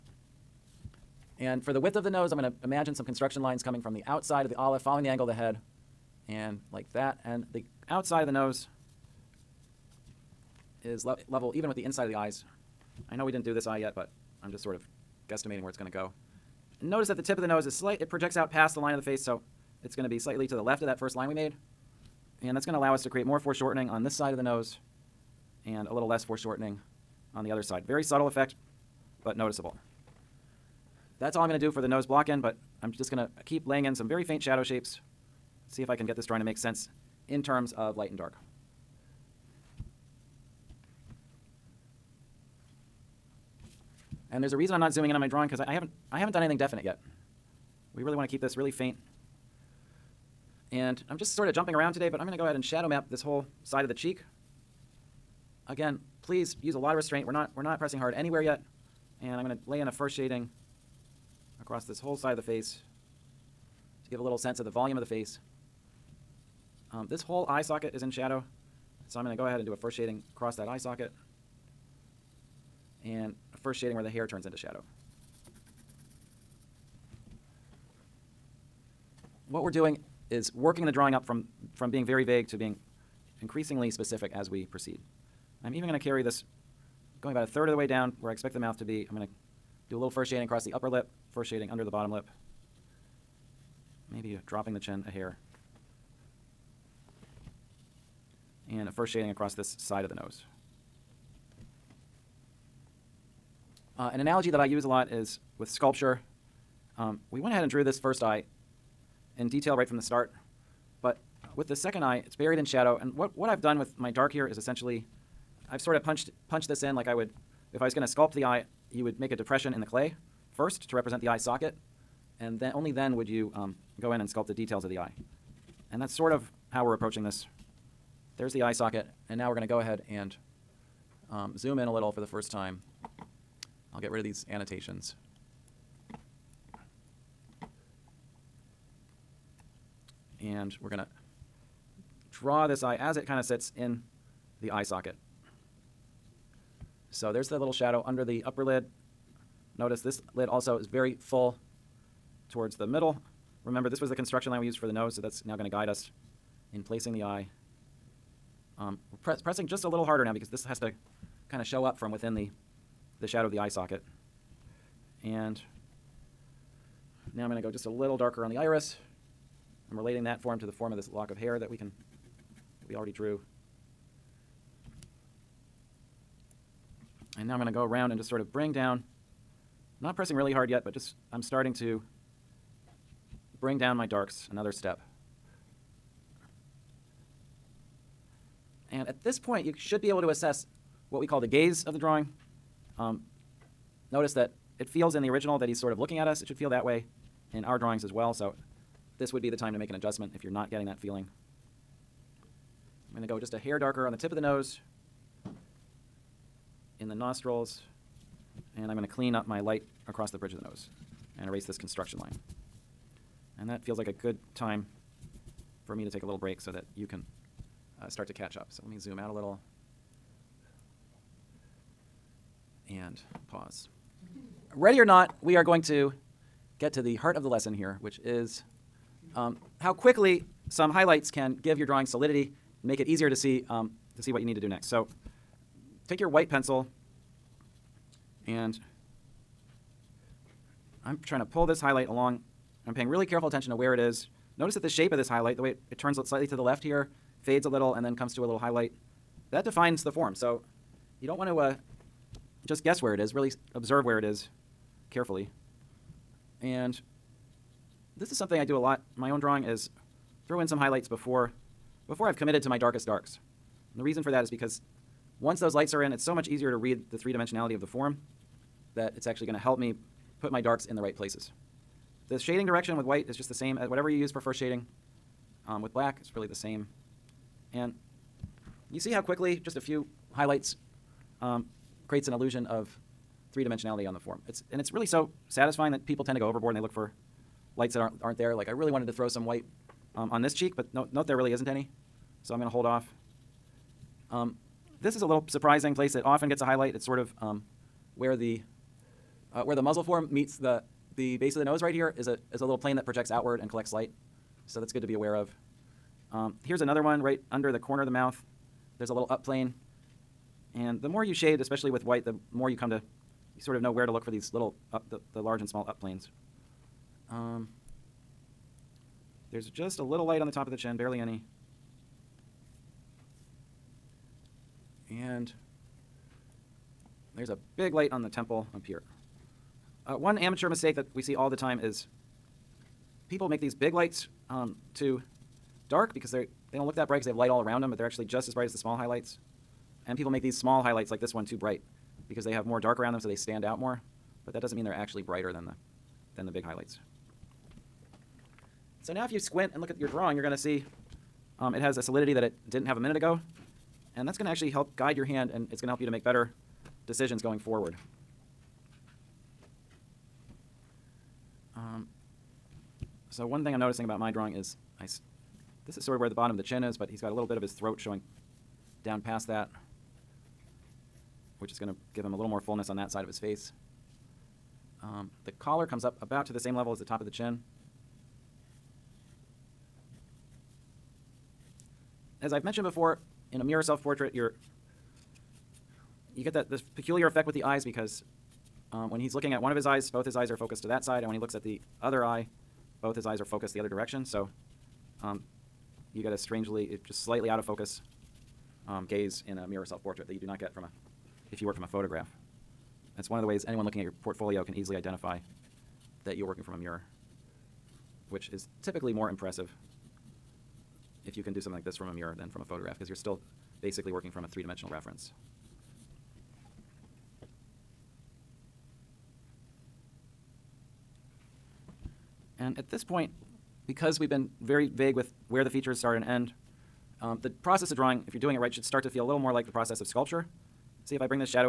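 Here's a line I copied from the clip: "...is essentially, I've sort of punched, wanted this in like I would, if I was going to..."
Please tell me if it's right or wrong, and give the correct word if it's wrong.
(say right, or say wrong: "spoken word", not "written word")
wrong: "punched", not "wanted".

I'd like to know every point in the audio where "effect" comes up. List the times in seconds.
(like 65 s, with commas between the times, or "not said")
28 s, 387 s.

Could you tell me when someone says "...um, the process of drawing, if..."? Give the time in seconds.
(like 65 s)
427 s.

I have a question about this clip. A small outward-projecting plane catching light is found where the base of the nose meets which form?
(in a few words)
The muzzle.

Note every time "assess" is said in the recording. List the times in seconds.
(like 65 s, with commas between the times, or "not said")
190 s.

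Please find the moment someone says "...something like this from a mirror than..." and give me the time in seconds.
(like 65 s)
411 s.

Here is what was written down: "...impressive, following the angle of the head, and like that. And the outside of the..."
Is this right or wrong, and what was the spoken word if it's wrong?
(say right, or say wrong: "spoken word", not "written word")
wrong: "olive", not "impressive".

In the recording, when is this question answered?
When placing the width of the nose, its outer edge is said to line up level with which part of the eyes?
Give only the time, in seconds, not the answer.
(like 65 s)
11 s.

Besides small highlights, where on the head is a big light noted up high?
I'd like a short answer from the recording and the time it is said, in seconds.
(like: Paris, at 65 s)
The temple, at 328 s.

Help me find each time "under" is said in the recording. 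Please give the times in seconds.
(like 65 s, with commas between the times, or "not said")
91 s, 148 s, 307 s.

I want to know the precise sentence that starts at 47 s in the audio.
We really want to keep this really faint.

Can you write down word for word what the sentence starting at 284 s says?
It's, and it's really so satisfying that people tend to go overboard and they look for lights that aren't, aren't there.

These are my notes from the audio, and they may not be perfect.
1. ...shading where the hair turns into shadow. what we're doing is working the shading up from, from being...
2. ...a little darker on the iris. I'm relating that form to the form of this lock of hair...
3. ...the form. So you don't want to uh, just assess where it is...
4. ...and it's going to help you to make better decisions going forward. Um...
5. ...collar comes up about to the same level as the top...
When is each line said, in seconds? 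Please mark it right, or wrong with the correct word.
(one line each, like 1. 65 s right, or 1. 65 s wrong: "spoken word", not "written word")
1. 73 s wrong: "drawing", not "shading"
2. 167 s right
3. 250 s wrong: "guess", not "assess"
4. 355 s right
5. 375 s right.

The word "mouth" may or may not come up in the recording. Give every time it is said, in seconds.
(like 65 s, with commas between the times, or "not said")
88 s, 308 s.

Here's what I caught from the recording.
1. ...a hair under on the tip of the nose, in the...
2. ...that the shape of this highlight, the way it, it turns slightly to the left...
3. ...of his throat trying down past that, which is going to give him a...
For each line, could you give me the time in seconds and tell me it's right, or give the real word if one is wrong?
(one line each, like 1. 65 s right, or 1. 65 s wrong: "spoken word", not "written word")
1. 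203 s wrong: "darker", not "under"
2. 244 s right
3. 367 s wrong: "showing", not "trying".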